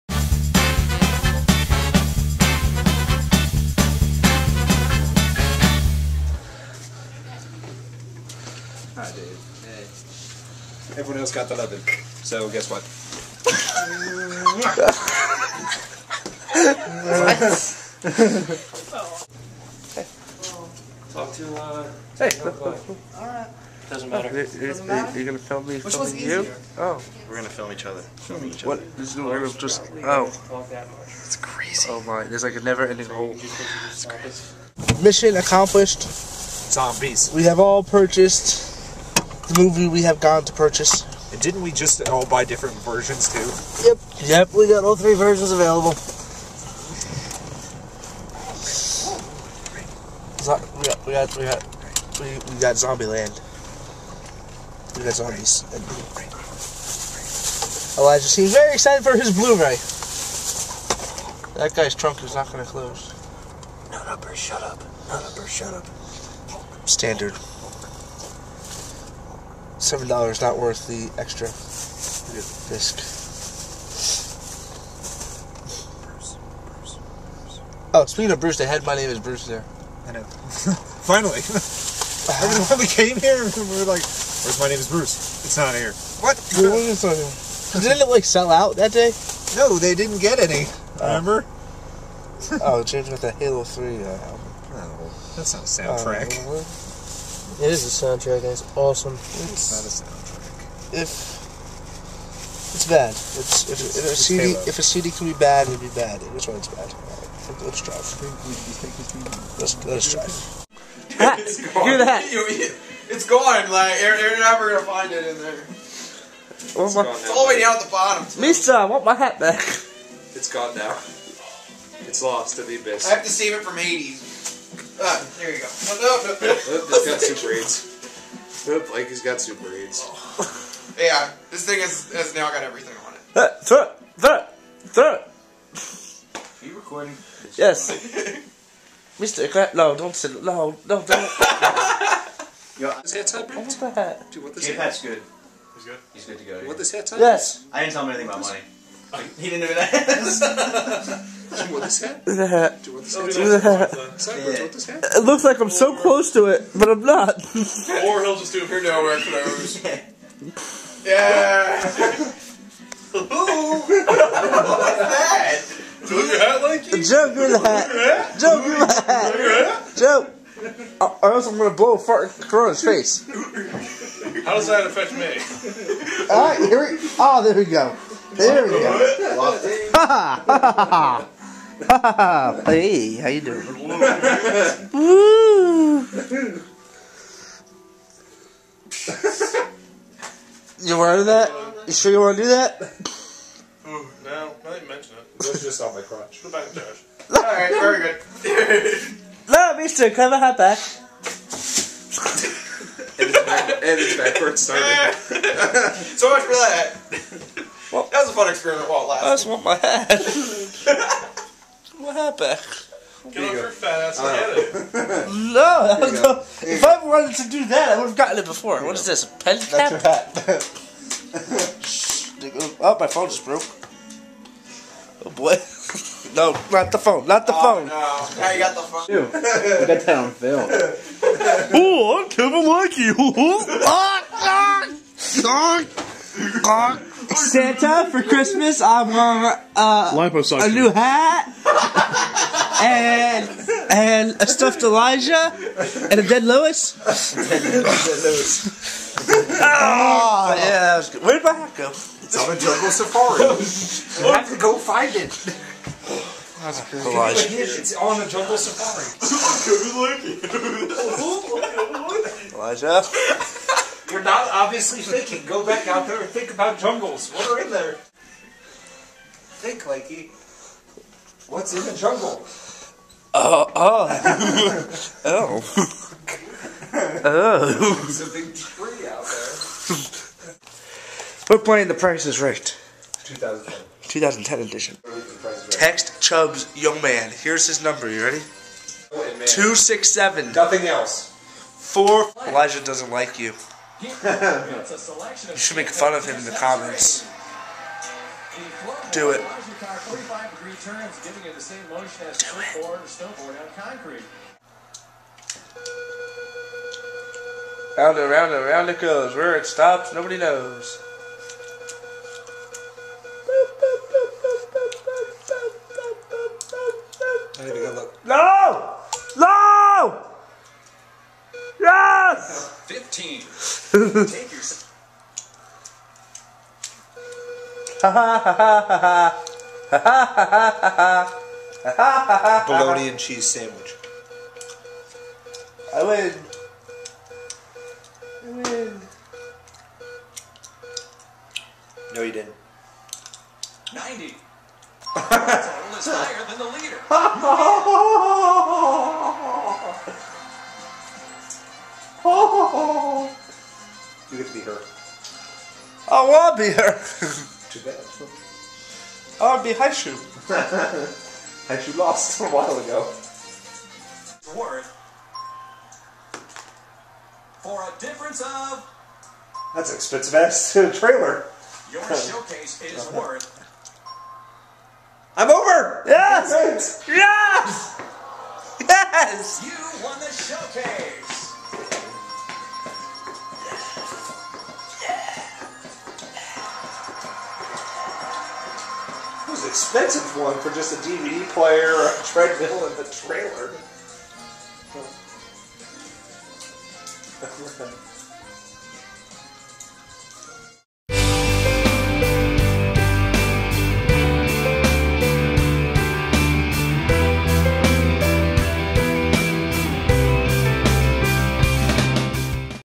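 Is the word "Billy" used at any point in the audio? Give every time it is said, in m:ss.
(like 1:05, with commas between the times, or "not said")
not said.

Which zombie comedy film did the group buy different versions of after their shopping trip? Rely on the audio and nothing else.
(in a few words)
Zombieland.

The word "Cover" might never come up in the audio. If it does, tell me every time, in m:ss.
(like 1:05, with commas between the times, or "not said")
3:20.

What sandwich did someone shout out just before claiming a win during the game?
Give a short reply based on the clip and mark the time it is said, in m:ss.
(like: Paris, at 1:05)
Bologna and cheese, at 5:23.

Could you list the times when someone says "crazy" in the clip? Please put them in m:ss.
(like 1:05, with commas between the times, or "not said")
0:31, 4:16.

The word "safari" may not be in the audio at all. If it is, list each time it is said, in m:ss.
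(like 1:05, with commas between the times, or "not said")
4:12, 4:18.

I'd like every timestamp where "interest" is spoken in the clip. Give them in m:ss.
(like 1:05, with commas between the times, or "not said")
not said.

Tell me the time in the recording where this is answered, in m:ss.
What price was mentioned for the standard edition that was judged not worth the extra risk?
1:09.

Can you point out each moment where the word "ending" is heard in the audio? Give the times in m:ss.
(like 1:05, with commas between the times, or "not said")
0:32.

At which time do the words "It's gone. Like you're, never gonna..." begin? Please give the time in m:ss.
1:52.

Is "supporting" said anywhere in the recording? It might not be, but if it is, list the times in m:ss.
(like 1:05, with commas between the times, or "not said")
not said.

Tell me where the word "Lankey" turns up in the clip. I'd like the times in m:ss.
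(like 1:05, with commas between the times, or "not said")
3:52, 4:29.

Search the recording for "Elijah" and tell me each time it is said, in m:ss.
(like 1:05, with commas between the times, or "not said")
0:57, 4:04, 4:17, 4:22, 4:52.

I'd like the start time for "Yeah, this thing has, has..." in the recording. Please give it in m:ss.
2:10.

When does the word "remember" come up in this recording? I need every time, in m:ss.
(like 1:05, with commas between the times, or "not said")
1:21, 1:31.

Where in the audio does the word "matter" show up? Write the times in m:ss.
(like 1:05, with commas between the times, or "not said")
0:24.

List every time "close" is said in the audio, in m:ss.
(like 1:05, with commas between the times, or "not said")
1:02, 2:36.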